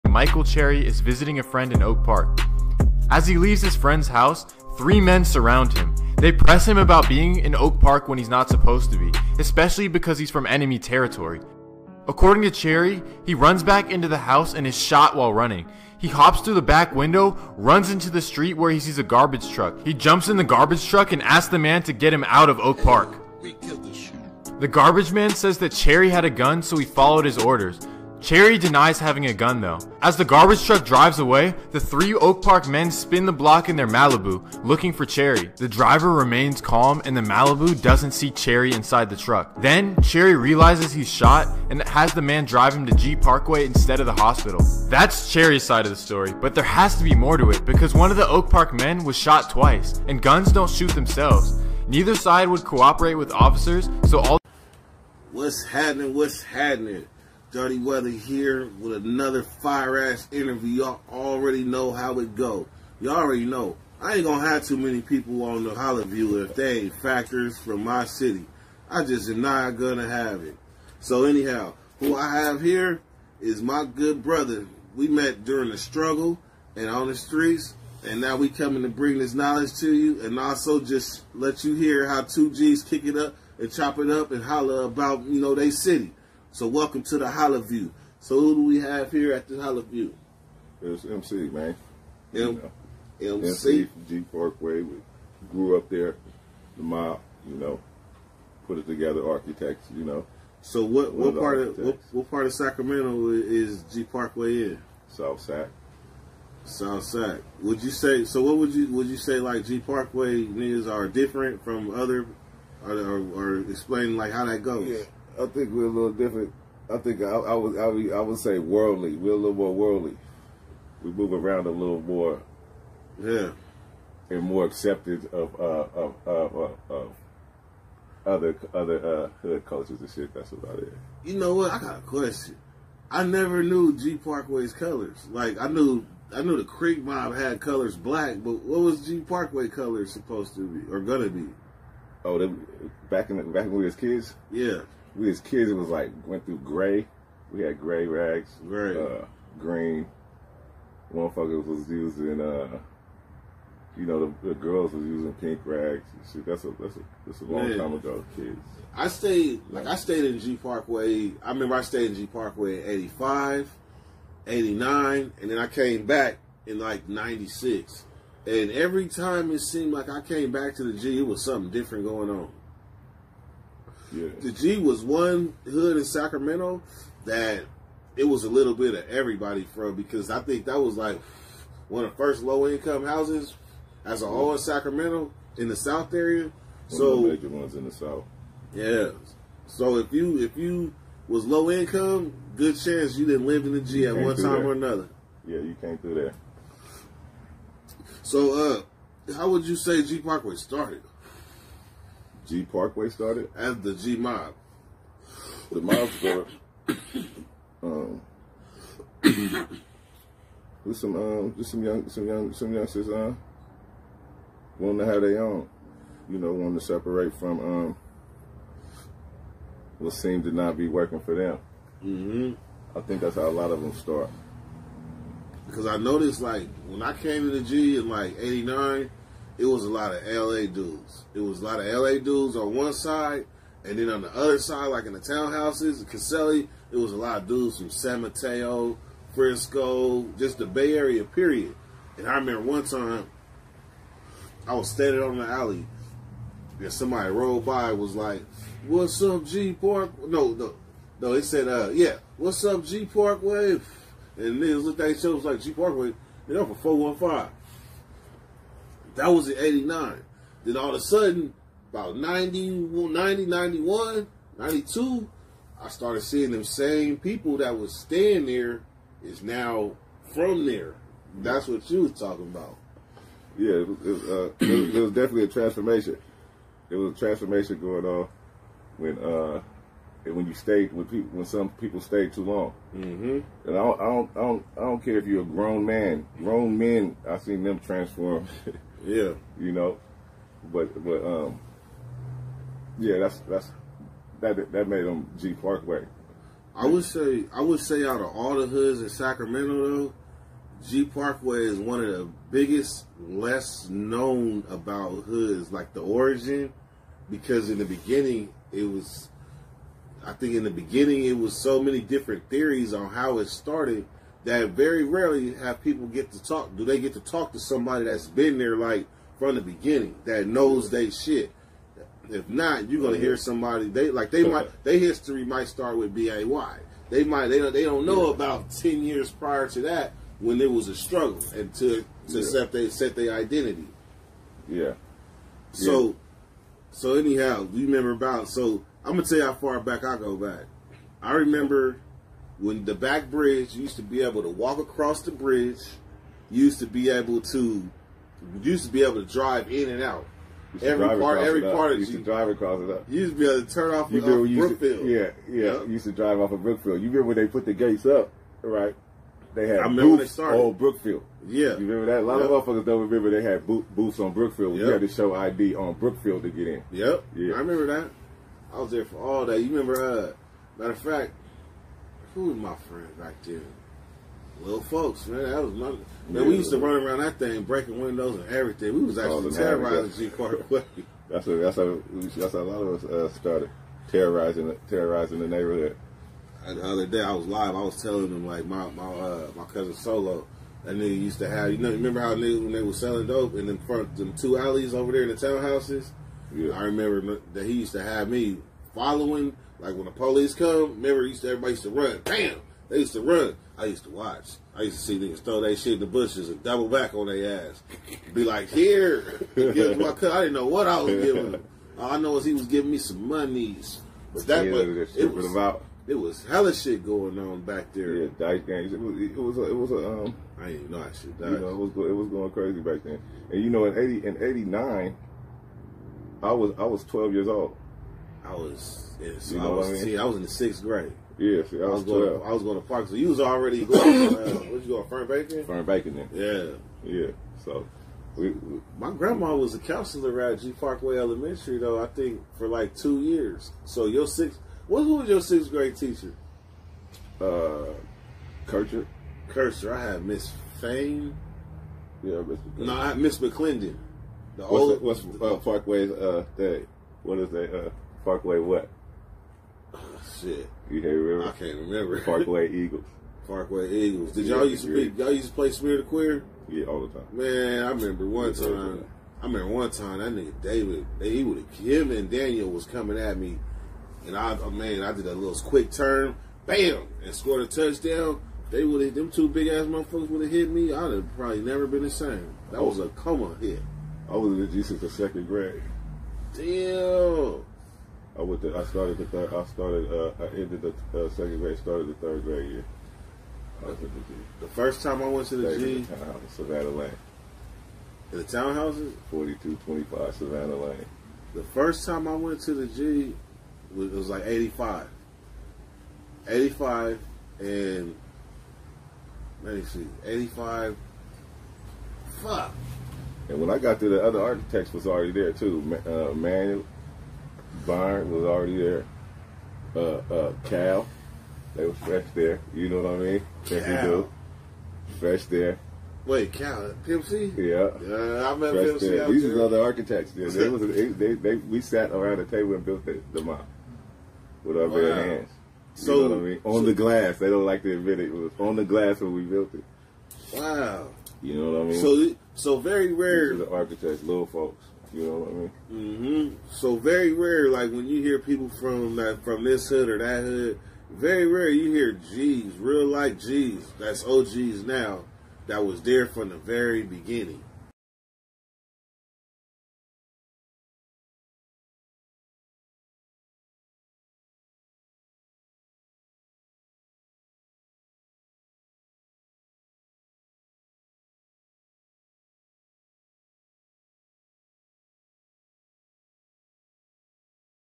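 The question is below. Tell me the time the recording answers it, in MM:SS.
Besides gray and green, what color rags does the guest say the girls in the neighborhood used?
02:35.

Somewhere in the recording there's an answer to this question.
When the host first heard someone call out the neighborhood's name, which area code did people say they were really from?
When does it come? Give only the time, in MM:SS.
04:17.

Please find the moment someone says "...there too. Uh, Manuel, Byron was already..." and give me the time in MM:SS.
08:35.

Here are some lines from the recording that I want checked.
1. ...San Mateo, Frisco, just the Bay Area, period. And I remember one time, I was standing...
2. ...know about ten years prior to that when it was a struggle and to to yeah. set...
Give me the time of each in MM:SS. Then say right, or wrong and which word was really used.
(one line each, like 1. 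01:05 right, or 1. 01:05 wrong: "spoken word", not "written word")
1. 03:57 right
2. 05:28 right.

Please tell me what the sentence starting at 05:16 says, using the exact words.
Do they get to talk to somebody that's been there like from the beginning that knows they shit?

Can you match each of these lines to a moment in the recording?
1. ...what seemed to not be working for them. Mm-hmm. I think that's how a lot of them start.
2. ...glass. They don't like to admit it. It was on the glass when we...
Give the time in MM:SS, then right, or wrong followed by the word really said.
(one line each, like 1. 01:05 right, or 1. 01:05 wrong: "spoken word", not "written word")
1. 03:39 right
2. 08:56 right.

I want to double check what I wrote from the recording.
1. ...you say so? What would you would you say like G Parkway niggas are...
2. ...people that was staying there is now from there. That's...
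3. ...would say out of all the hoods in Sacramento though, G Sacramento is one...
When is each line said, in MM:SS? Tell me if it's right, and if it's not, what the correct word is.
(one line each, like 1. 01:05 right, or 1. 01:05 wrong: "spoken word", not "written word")
1. 01:47 right
2. 04:27 right
3. 04:57 wrong: "Parkway", not "Sacramento".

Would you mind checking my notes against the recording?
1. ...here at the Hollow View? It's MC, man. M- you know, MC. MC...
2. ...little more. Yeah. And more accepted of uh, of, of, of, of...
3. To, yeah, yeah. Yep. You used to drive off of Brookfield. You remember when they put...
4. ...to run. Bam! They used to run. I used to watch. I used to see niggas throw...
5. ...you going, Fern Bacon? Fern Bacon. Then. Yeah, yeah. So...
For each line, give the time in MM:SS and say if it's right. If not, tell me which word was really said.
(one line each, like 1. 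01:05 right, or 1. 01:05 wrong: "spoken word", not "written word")
1. 01:29 right
2. 02:01 right
3. 05:54 right
4. 06:41 right
5. 07:14 right.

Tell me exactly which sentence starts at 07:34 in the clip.
The what's old, that, what's uh, Parkway's uh, that?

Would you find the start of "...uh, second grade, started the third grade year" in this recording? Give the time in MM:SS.
08:11.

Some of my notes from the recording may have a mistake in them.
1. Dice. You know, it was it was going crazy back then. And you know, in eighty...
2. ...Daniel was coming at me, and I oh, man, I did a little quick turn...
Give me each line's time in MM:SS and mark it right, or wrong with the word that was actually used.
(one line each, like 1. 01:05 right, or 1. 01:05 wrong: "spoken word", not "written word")
1. 07:01 right
2. 07:52 right.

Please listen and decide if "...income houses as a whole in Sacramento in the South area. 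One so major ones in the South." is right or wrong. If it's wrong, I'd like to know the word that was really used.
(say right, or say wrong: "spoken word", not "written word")
right.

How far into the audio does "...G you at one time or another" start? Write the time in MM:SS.
03:13.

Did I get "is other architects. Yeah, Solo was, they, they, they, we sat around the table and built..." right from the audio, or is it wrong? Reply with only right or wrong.
wrong.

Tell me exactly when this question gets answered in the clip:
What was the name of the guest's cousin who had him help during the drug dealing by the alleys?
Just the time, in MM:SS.
06:29.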